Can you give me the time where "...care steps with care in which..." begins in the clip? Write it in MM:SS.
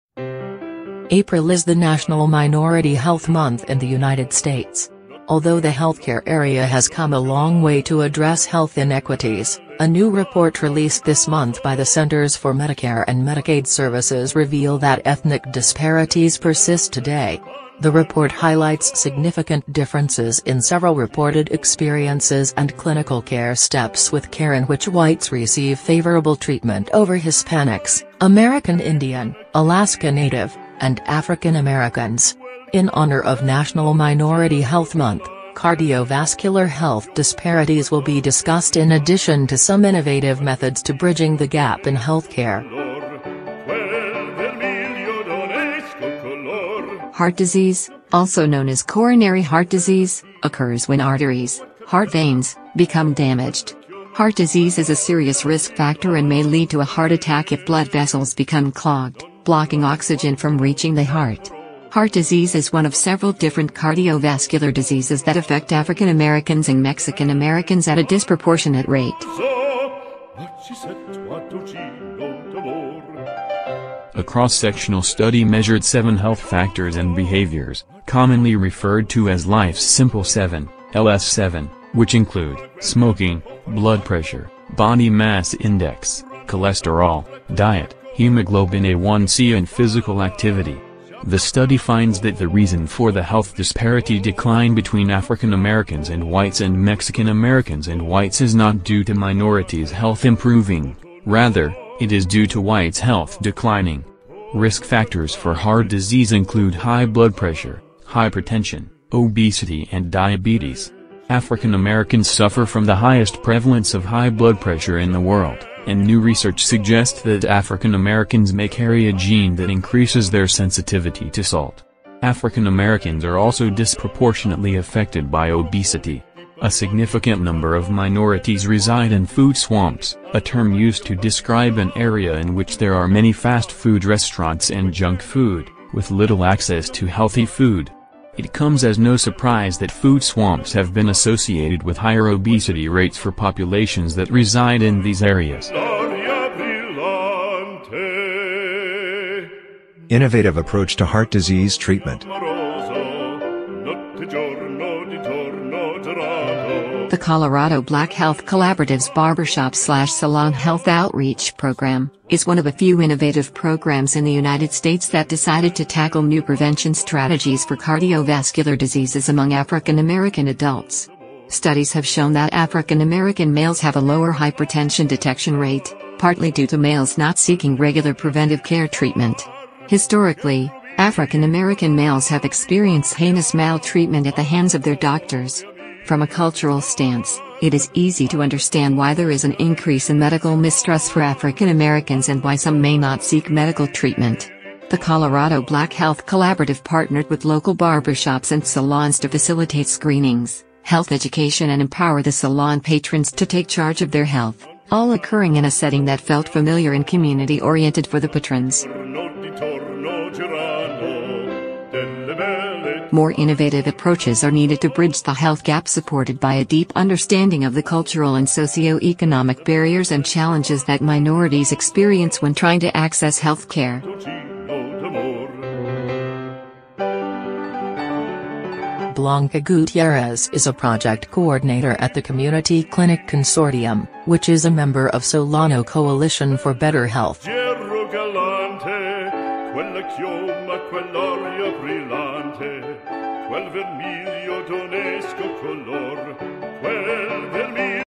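00:23.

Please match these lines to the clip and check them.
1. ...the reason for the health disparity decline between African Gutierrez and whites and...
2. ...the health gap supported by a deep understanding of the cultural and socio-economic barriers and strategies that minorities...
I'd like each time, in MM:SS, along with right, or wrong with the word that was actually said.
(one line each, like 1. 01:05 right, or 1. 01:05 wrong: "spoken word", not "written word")
1. 01:32 wrong: "Americans", not "Gutierrez"
2. 03:35 wrong: "challenges", not "strategies".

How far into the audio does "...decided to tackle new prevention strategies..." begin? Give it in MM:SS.
02:45.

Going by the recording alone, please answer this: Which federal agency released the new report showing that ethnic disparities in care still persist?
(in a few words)
Centers for Medicare and Medicaid Services.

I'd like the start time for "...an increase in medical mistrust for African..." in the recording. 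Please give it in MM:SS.
03:09.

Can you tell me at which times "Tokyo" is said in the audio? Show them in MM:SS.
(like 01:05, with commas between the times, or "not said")
not said.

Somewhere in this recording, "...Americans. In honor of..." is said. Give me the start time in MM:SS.
00:31.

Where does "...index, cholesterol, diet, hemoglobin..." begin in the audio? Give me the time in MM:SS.
01:25.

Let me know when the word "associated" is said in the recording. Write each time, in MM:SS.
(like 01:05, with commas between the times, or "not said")
02:21.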